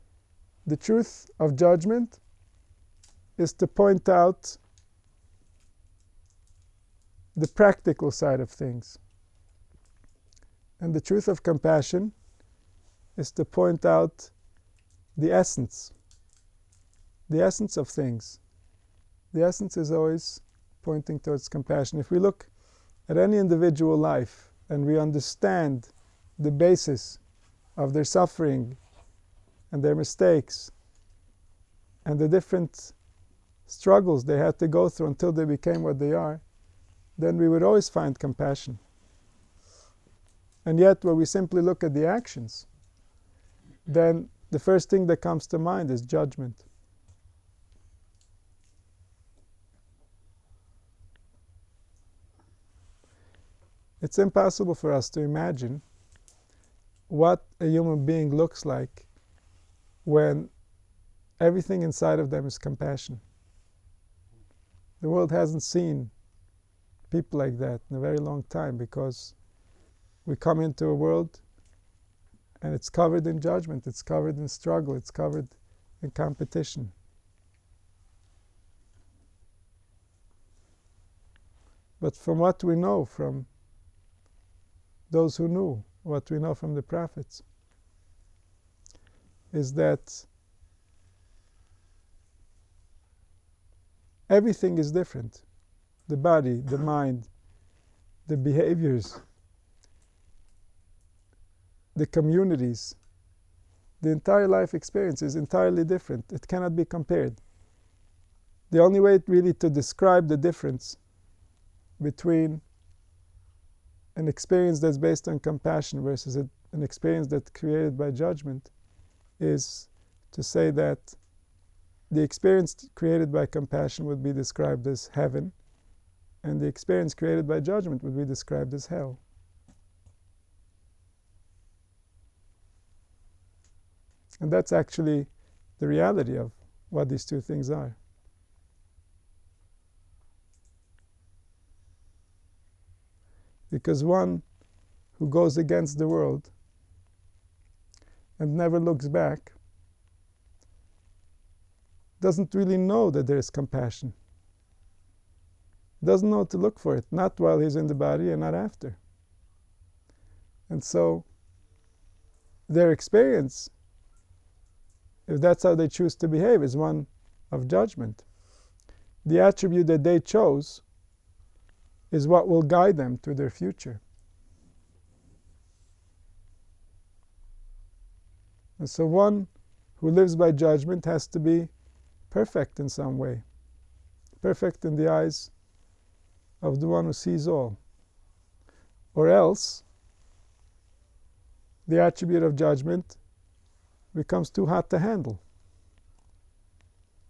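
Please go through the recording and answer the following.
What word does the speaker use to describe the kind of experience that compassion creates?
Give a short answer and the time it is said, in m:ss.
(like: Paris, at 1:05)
Heaven, at 2:05.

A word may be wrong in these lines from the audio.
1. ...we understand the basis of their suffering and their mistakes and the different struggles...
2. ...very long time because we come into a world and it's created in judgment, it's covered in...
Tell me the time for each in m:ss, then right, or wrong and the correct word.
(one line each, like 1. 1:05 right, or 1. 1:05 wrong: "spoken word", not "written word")
1. 0:24 right
2. 1:07 wrong: "covered", not "created".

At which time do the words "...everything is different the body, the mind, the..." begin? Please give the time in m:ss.
1:34.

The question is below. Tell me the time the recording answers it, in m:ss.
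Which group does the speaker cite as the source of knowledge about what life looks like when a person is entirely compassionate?
1:26.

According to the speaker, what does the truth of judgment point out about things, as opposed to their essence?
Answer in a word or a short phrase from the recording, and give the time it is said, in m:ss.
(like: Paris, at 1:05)
The practical side, at 0:07.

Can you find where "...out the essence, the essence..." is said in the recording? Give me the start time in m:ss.
0:13.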